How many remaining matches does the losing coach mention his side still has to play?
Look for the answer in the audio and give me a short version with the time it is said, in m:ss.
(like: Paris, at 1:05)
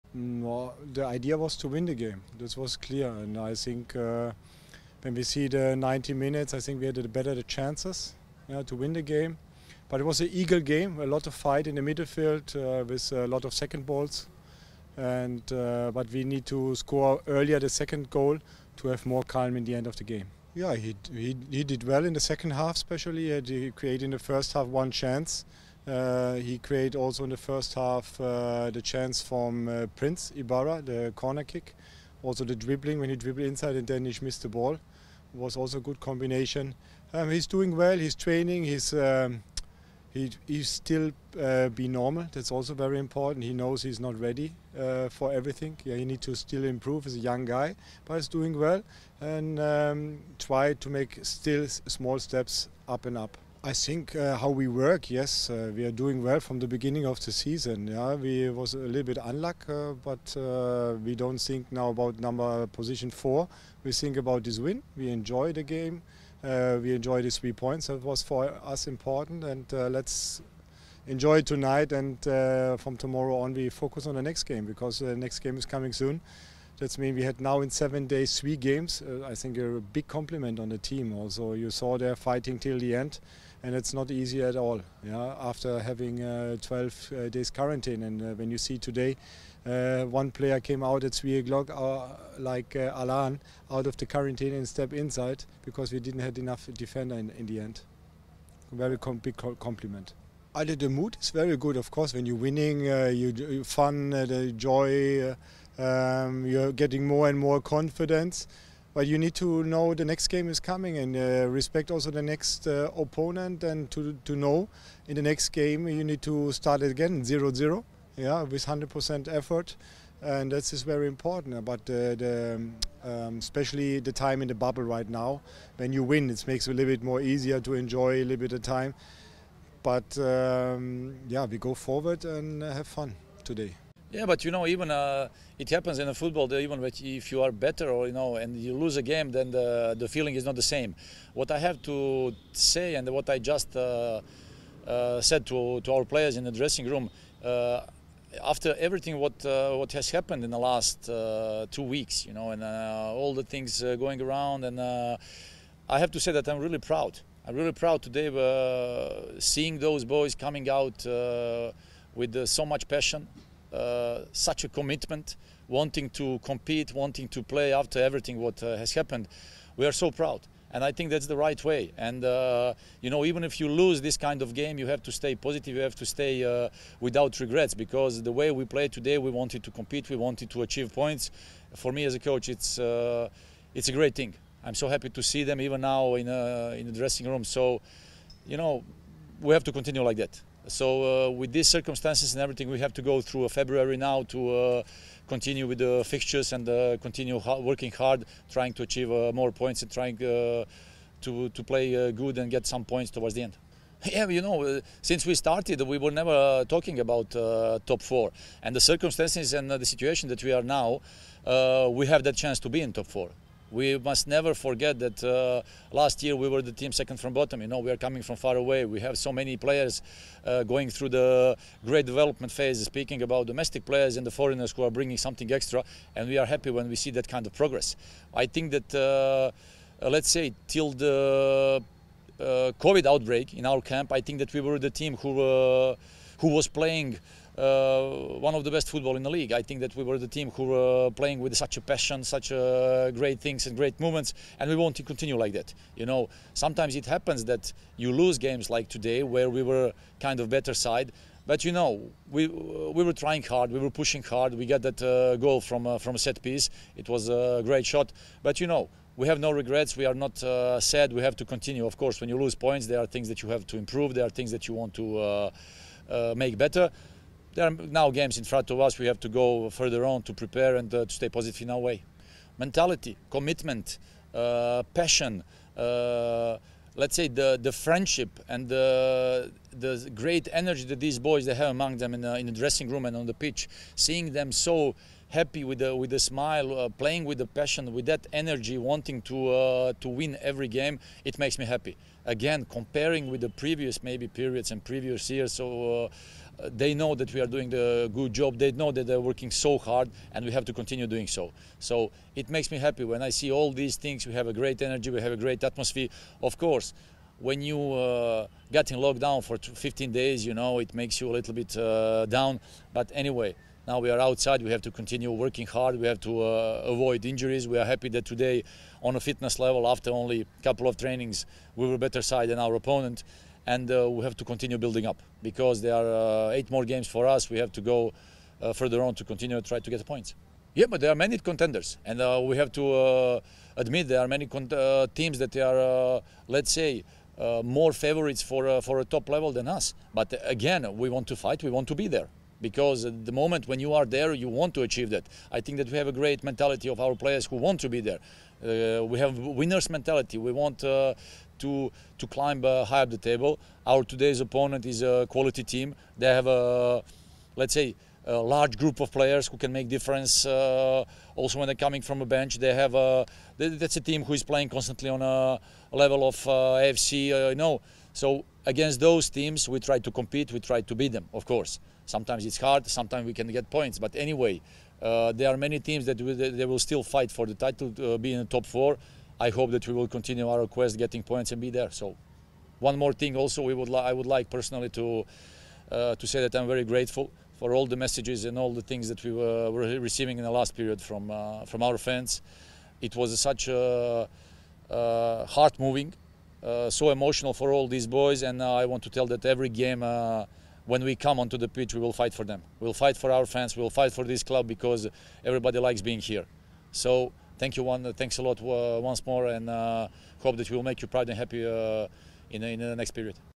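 8, at 5:26.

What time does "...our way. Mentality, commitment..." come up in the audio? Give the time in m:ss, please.
4:31.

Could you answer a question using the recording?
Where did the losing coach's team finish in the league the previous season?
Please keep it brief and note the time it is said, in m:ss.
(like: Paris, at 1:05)
second from bottom, at 3:36.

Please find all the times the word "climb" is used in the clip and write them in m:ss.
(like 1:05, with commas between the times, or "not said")
5:52.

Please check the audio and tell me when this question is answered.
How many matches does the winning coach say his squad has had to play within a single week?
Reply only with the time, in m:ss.
1:18.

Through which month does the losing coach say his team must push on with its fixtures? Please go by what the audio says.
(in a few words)
February.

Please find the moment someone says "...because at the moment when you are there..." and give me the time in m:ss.
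5:42.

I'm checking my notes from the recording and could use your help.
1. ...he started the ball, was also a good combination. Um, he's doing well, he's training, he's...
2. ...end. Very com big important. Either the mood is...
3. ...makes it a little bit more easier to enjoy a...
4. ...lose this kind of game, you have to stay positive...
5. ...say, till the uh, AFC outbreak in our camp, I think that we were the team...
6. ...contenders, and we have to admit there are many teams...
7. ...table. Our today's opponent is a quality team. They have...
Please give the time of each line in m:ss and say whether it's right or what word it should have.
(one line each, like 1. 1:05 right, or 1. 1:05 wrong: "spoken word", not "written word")
1. 0:34 wrong: "missed", not "started"
2. 1:37 wrong: "compliment", not "important"
3. 2:06 right
4. 2:53 right
5. 3:50 wrong: "COVID", not "AFC"
6. 5:31 right
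7. 5:53 right.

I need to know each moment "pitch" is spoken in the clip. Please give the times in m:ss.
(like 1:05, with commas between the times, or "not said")
4:43, 6:41.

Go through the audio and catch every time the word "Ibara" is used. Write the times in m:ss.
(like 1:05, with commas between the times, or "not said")
0:30.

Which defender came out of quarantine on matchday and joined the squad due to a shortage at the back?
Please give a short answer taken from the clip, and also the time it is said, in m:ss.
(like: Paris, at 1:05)
Alan, at 1:32.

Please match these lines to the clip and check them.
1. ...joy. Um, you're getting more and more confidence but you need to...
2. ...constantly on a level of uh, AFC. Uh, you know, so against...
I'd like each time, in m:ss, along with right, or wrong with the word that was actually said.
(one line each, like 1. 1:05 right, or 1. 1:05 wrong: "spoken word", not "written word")
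1. 1:44 right
2. 6:04 right.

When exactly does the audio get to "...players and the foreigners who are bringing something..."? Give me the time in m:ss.
3:43.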